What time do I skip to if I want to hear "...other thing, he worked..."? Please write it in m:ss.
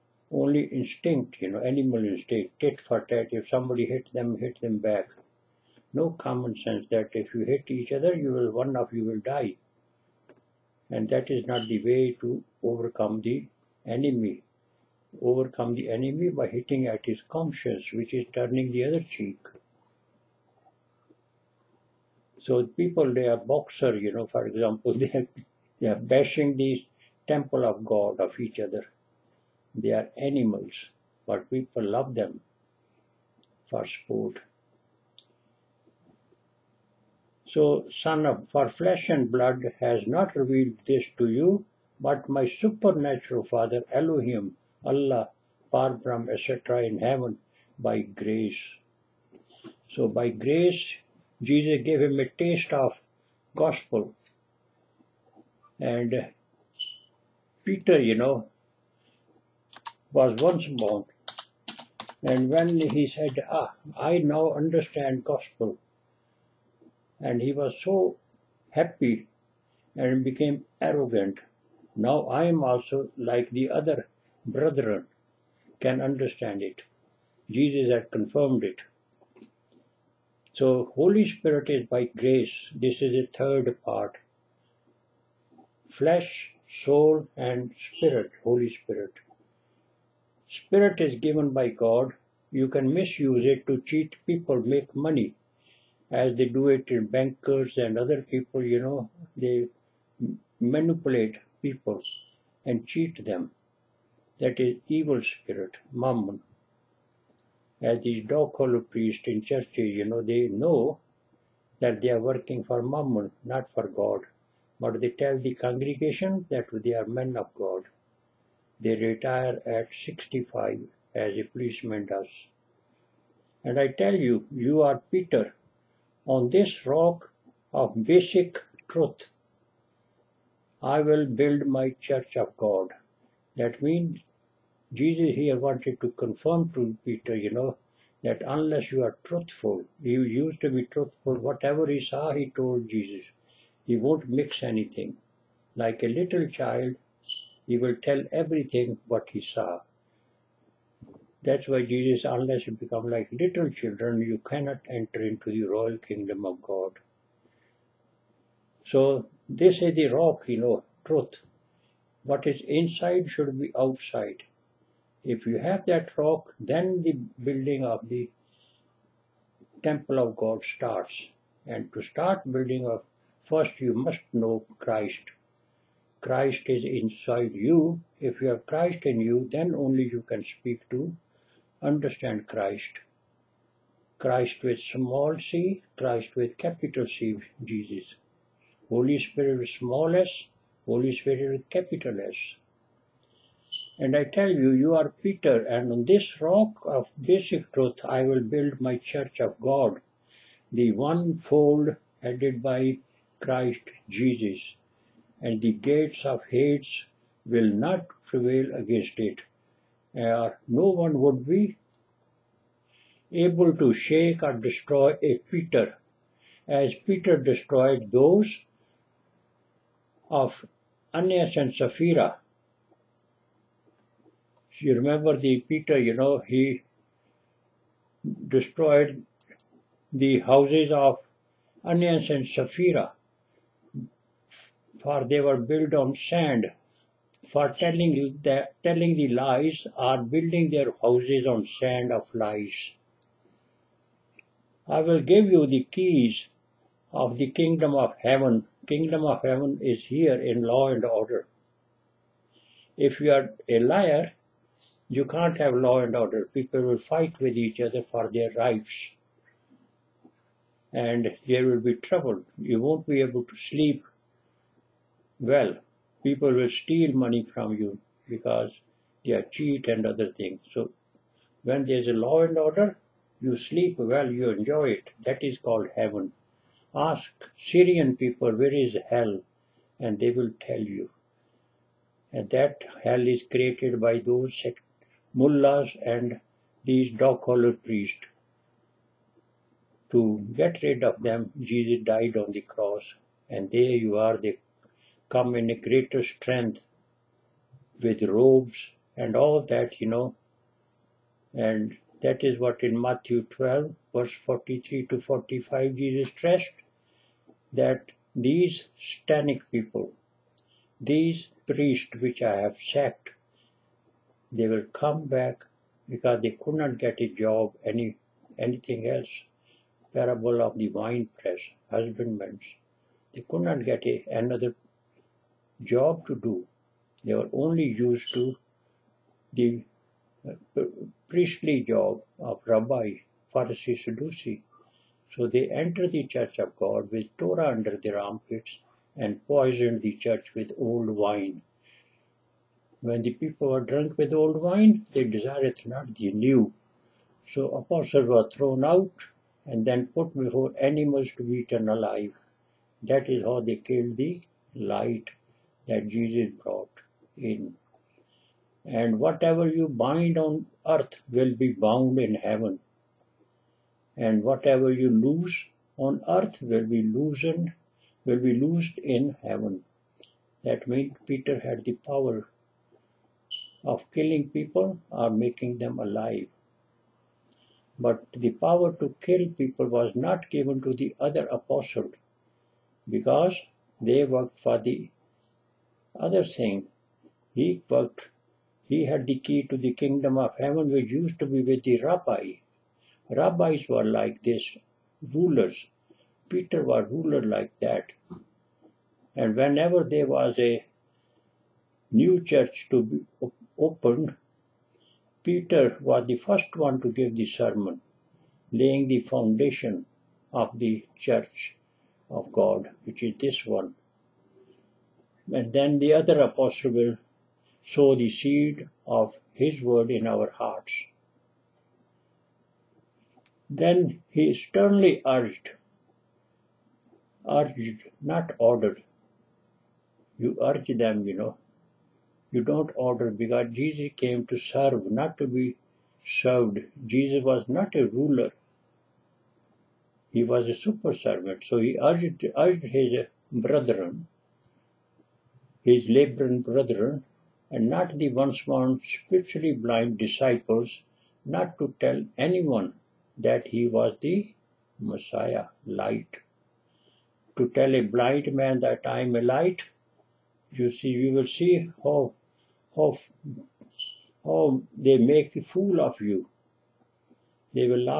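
6:26.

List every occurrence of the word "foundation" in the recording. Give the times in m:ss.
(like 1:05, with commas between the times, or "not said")
6:49.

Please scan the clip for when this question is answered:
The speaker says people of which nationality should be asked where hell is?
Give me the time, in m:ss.
4:37.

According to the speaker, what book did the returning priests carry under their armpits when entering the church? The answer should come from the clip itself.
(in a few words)
Torah.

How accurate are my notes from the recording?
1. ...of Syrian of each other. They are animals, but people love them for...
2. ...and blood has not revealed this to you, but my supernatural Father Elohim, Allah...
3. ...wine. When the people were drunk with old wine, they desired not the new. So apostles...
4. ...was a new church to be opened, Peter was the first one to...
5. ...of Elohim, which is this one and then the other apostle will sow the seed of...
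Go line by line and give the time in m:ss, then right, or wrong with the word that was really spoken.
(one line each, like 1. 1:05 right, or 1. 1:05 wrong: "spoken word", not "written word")
1. 0:27 wrong: "God", not "Syrian"
2. 0:39 right
3. 5:41 right
4. 6:40 right
5. 6:52 wrong: "God", not "Elohim".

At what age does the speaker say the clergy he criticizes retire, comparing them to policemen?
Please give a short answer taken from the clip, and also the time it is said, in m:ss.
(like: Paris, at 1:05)
65, at 1:59.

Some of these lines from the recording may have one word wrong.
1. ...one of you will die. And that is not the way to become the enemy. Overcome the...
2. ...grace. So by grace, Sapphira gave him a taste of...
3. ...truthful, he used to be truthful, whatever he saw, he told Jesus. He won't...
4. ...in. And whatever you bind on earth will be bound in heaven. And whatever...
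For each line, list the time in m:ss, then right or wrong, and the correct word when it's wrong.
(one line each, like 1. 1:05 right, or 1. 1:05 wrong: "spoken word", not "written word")
1. 0:08 wrong: "overcome", not "become"
2. 0:48 wrong: "Jesus", not "Sapphira"
3. 2:19 right
4. 5:57 right.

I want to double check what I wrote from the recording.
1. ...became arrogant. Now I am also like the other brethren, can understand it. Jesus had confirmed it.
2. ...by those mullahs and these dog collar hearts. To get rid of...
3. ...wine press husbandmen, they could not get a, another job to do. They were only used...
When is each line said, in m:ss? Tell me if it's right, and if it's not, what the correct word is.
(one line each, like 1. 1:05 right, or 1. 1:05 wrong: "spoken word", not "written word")
1. 1:10 right
2. 4:44 wrong: "priests", not "hearts"
3. 5:20 right.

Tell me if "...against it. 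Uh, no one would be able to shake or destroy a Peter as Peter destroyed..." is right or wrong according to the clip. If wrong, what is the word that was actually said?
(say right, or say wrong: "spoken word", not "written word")
right.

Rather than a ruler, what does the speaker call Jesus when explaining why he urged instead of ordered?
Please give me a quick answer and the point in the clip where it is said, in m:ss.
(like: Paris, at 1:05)
super servant, at 7:20.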